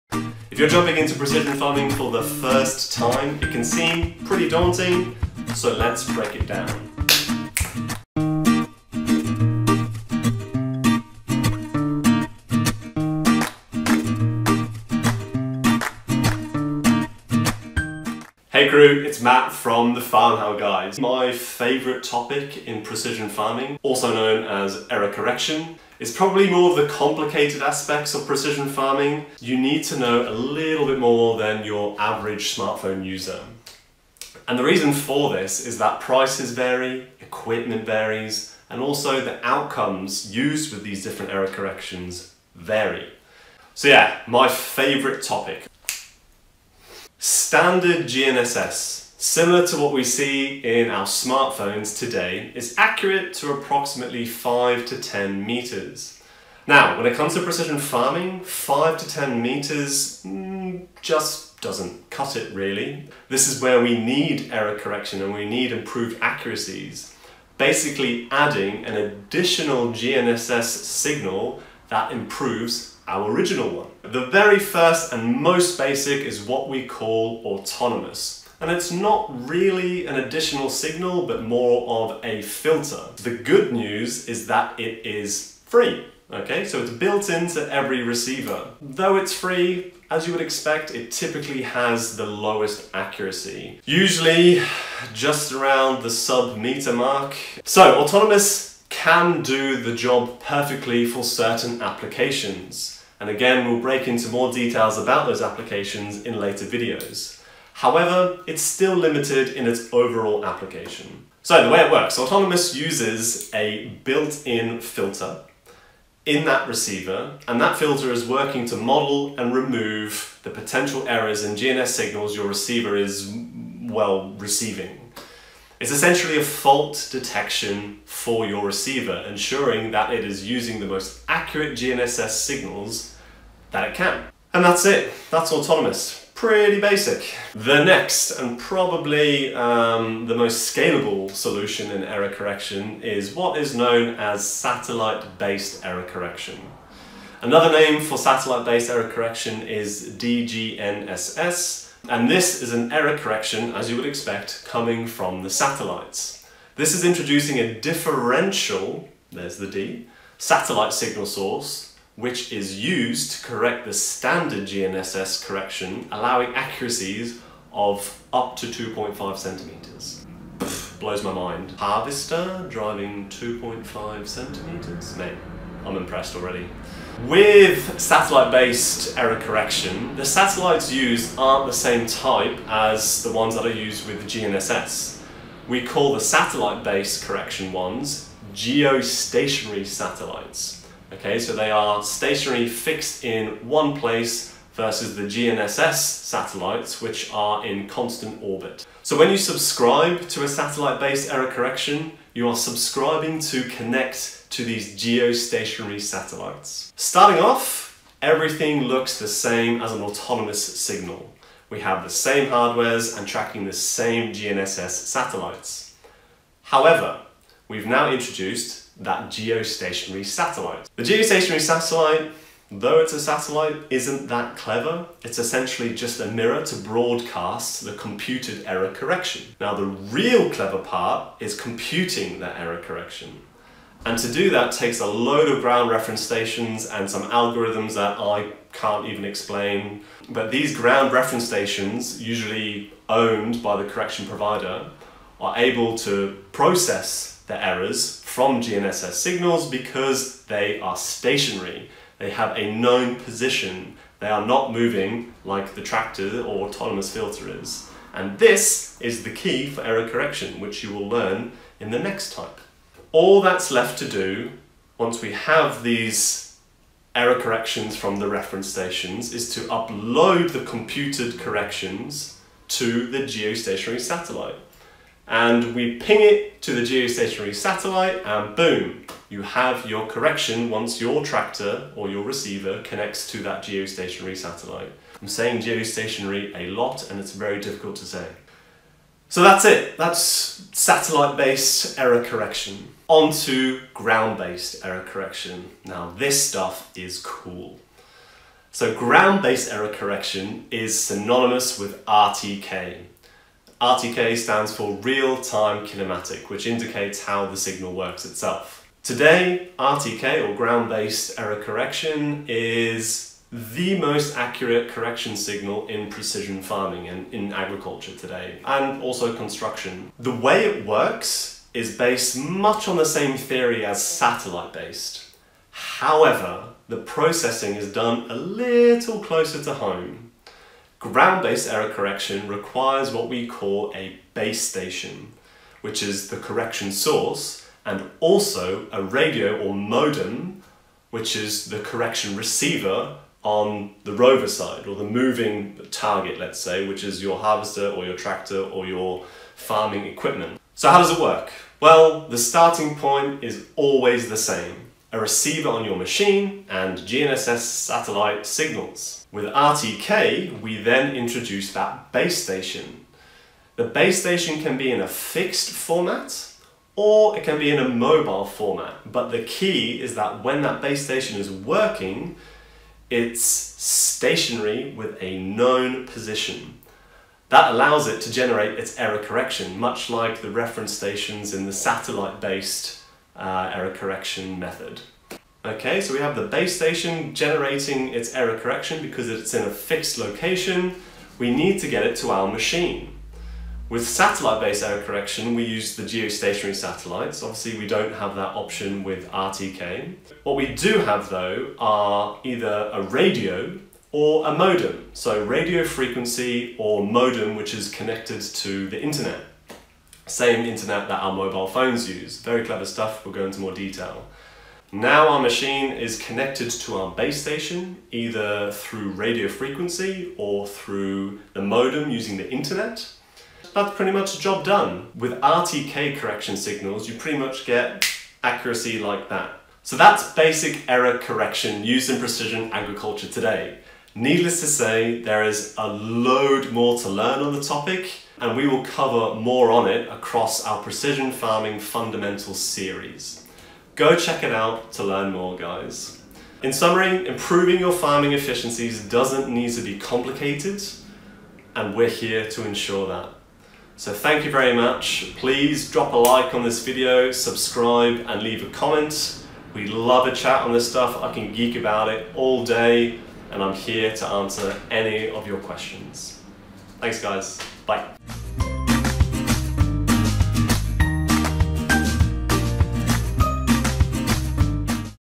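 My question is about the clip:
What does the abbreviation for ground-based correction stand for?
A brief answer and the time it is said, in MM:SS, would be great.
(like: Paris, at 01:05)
Real-time kinematic, at 05:04.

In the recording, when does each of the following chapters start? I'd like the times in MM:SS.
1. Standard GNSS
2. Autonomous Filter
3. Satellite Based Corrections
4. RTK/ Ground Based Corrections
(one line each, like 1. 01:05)
1. 00:47
2. 01:14
3. 02:18
4. 05:54.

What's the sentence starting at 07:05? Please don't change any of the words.
With RTK correction signals, you pretty much get accuracy like that.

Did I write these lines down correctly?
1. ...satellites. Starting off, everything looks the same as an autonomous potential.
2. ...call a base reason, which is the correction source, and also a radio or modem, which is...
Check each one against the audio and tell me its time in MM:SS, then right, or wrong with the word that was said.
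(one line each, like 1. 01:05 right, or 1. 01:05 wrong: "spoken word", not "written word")
1. 03:25 wrong: "signal", not "potential"
2. 05:33 wrong: "station", not "reason".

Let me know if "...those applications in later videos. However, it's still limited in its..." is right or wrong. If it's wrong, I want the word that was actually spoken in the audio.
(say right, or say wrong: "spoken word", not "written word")
right.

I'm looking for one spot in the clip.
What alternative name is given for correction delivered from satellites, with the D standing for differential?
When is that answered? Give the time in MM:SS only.
02:30.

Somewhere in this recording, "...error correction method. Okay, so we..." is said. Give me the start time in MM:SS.
06:23.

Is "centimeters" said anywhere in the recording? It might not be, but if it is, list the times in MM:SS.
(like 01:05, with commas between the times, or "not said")
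02:49, 02:54.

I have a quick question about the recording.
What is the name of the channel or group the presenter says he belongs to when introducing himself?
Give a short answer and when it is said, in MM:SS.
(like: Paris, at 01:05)
Farm How Guys, at 00:20.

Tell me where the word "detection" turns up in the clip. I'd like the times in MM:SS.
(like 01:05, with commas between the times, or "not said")
02:07.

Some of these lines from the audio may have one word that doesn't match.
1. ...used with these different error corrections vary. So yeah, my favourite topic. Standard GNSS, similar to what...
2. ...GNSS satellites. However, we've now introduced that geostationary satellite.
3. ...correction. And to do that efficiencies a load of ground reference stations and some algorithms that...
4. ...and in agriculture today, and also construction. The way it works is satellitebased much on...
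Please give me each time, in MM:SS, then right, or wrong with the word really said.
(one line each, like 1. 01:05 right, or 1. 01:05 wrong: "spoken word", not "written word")
1. 00:40 right
2. 03:34 right
3. 03:52 wrong: "takes", not "efficiencies"
4. 05:17 wrong: "based", not "satellitebased".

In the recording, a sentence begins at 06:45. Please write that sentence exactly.
So radio frequency or modem, which is connected to the internet.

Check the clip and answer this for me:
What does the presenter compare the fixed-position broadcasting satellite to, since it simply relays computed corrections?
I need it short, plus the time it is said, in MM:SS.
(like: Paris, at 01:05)
A mirror, at 03:46.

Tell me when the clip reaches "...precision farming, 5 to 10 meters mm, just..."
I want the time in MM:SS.
00:57.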